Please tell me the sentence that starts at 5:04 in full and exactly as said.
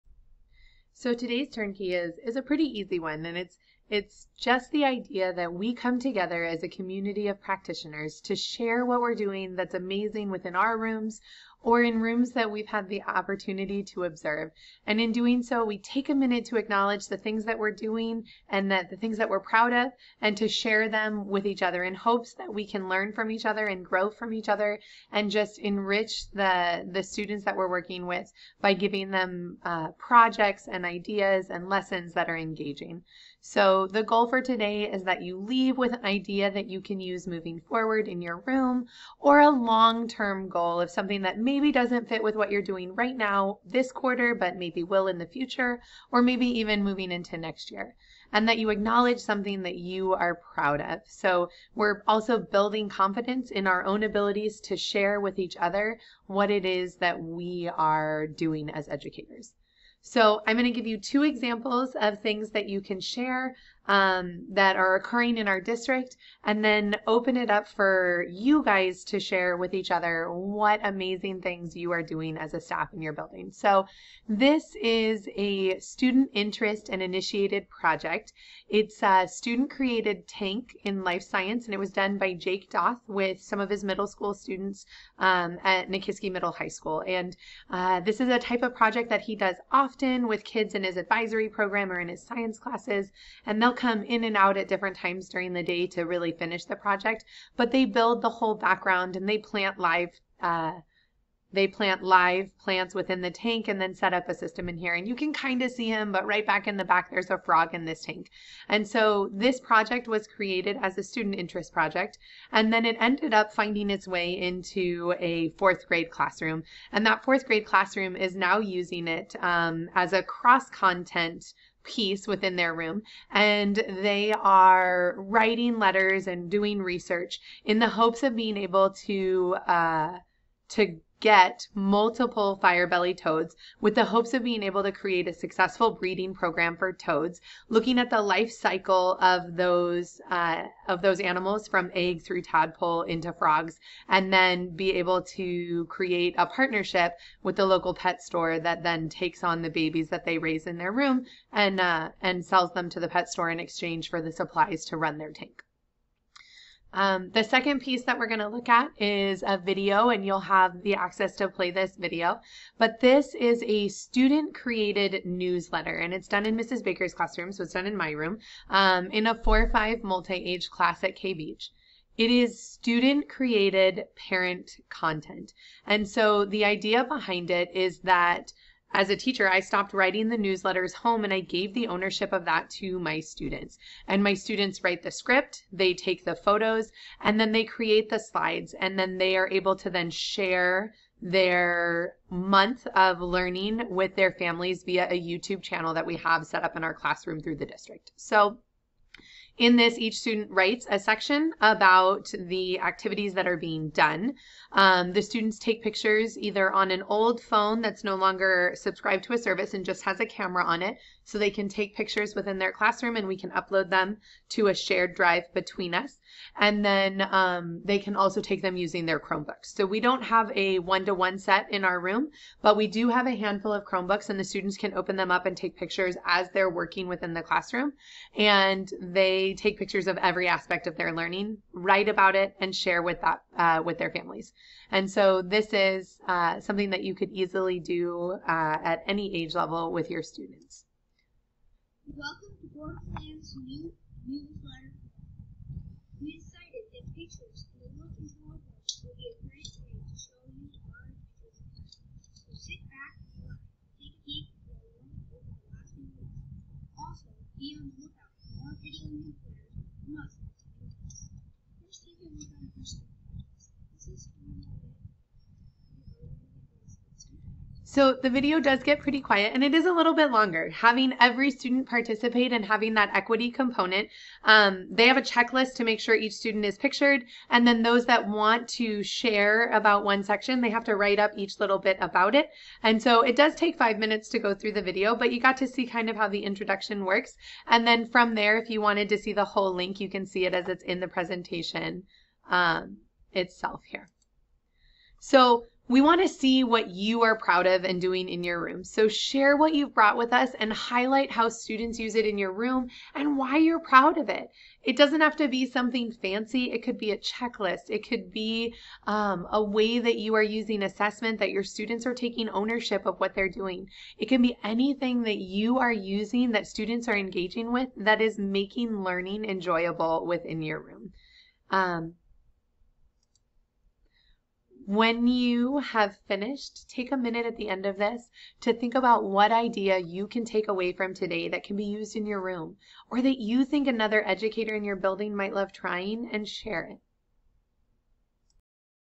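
It doesn't have to be something fancy.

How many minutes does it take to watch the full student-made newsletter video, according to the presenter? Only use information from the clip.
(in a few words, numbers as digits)
5.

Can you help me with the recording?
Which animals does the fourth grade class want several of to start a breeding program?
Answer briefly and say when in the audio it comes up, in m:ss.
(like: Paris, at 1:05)
fire belly toads, at 2:12.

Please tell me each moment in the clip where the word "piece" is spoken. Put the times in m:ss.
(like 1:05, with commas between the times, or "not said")
2:01, 2:37.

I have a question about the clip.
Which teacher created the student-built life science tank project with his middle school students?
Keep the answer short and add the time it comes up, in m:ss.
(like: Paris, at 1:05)
Jake Doth, at 1:22.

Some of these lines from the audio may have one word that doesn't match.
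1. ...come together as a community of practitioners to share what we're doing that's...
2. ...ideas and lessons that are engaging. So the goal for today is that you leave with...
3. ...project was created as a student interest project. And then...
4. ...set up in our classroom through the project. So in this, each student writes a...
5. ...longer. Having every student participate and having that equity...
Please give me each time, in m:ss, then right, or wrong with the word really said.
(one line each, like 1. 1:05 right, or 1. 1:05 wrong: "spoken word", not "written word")
1. 0:05 right
2. 0:30 right
3. 1:49 right
4. 3:16 wrong: "district", not "project"
5. 4:30 right.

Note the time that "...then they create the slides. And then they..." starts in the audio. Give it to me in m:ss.
3:07.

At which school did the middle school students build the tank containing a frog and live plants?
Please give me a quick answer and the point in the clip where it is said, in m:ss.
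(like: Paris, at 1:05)
Nikiski Middle High School, at 1:25.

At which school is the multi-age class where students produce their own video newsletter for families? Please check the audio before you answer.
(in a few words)
K-Beach.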